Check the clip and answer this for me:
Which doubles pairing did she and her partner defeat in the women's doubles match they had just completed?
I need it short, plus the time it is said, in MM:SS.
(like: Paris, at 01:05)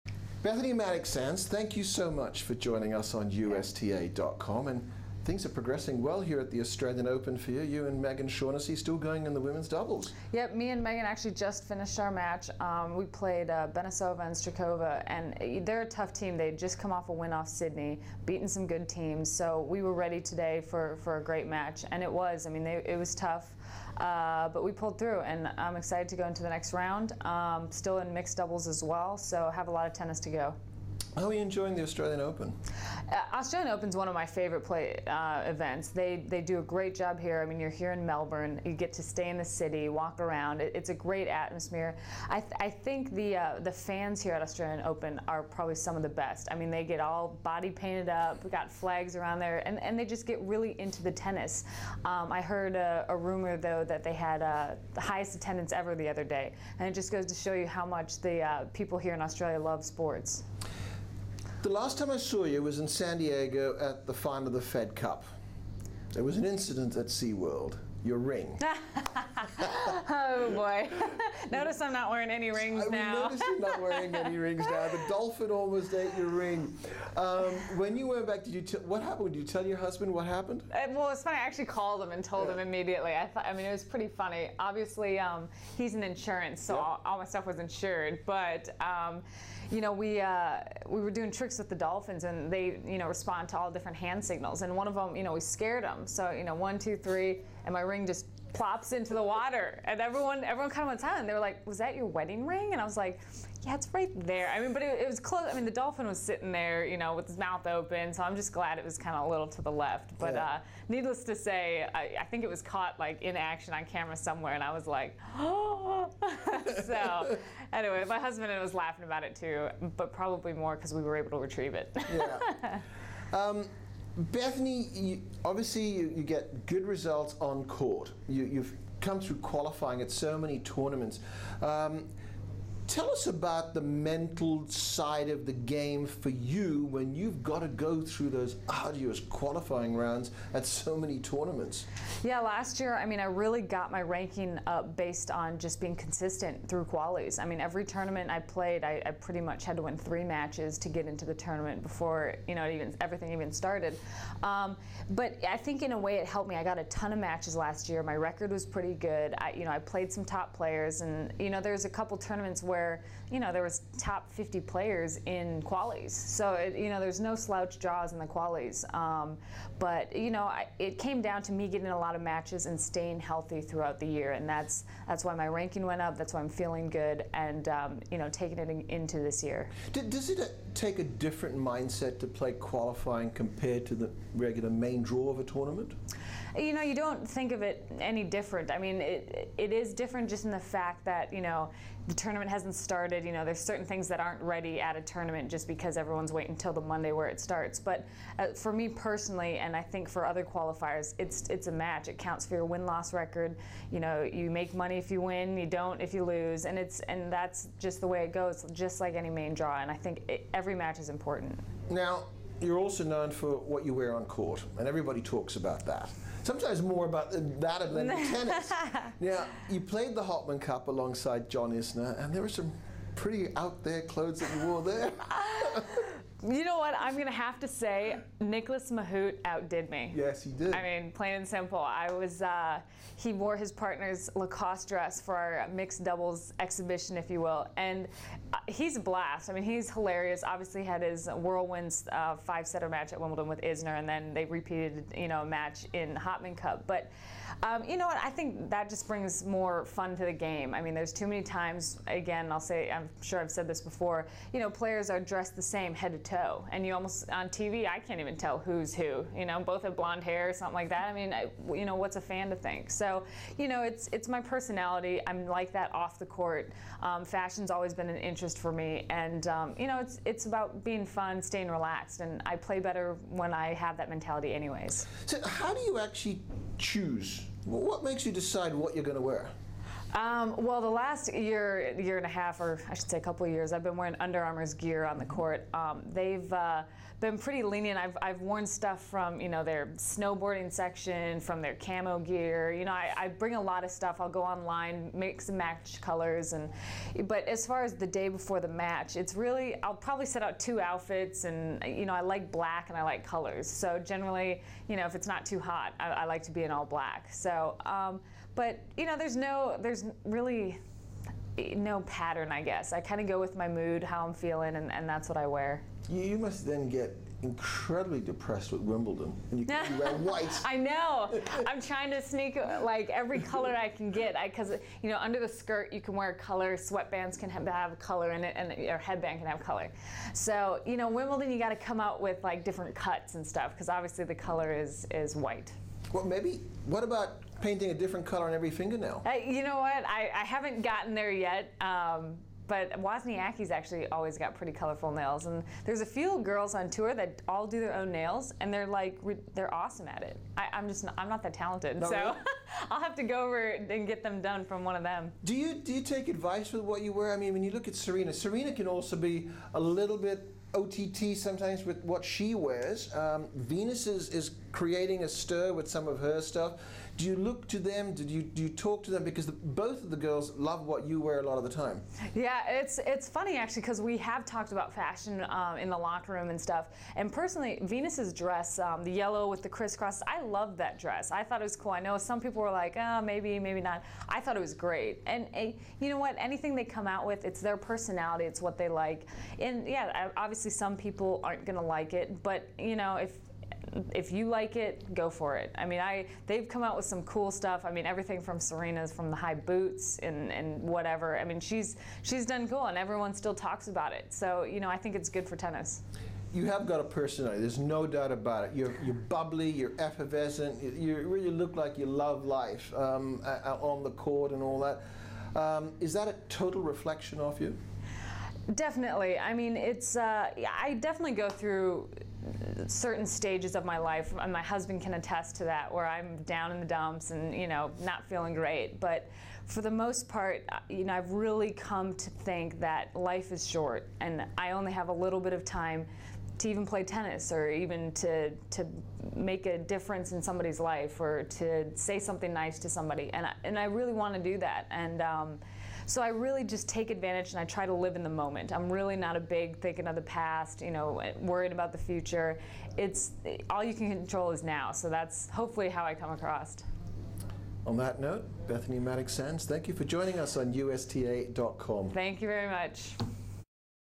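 Benesova and Strakova, at 00:13.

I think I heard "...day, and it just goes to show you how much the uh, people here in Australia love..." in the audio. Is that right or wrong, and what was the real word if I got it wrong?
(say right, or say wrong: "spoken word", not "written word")
right.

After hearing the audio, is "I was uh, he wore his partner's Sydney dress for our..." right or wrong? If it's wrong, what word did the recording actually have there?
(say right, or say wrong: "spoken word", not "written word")
wrong: "Lacoste", not "Sydney".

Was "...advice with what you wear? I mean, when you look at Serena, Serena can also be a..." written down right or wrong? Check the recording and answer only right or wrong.
right.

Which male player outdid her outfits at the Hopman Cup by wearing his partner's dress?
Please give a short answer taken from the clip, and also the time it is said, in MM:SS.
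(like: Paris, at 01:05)
Nicolas Mahut, at 03:48.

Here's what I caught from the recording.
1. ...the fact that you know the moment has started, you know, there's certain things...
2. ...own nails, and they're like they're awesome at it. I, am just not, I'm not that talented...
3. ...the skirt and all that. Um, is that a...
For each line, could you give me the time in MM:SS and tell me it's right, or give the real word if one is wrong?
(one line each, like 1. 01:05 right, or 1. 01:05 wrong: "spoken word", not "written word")
1. 03:10 wrong: "tournament", not "moment"
2. 05:47 right
3. 06:54 wrong: "court", not "skirt".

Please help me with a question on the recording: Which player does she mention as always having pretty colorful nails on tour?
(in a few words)
Wozniacki.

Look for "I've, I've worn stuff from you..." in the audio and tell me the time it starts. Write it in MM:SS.
04:47.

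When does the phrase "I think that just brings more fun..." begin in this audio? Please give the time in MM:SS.
04:08.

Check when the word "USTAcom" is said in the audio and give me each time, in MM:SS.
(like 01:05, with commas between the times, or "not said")
00:03, 07:40.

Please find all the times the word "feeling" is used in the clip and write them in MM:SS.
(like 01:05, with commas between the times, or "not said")
02:56, 05:14, 07:08.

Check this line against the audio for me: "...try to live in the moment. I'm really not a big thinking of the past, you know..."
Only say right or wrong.
right.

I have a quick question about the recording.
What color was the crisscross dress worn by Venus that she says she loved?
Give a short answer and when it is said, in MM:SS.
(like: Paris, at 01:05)
Yellow, at 06:19.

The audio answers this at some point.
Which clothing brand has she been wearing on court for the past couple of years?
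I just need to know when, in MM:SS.
04:44.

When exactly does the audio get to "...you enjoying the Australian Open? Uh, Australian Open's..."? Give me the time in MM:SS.
00:31.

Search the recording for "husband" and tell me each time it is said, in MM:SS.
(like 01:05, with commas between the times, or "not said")
01:19, 01:58, 07:04.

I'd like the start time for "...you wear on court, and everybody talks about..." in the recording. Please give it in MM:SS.
03:33.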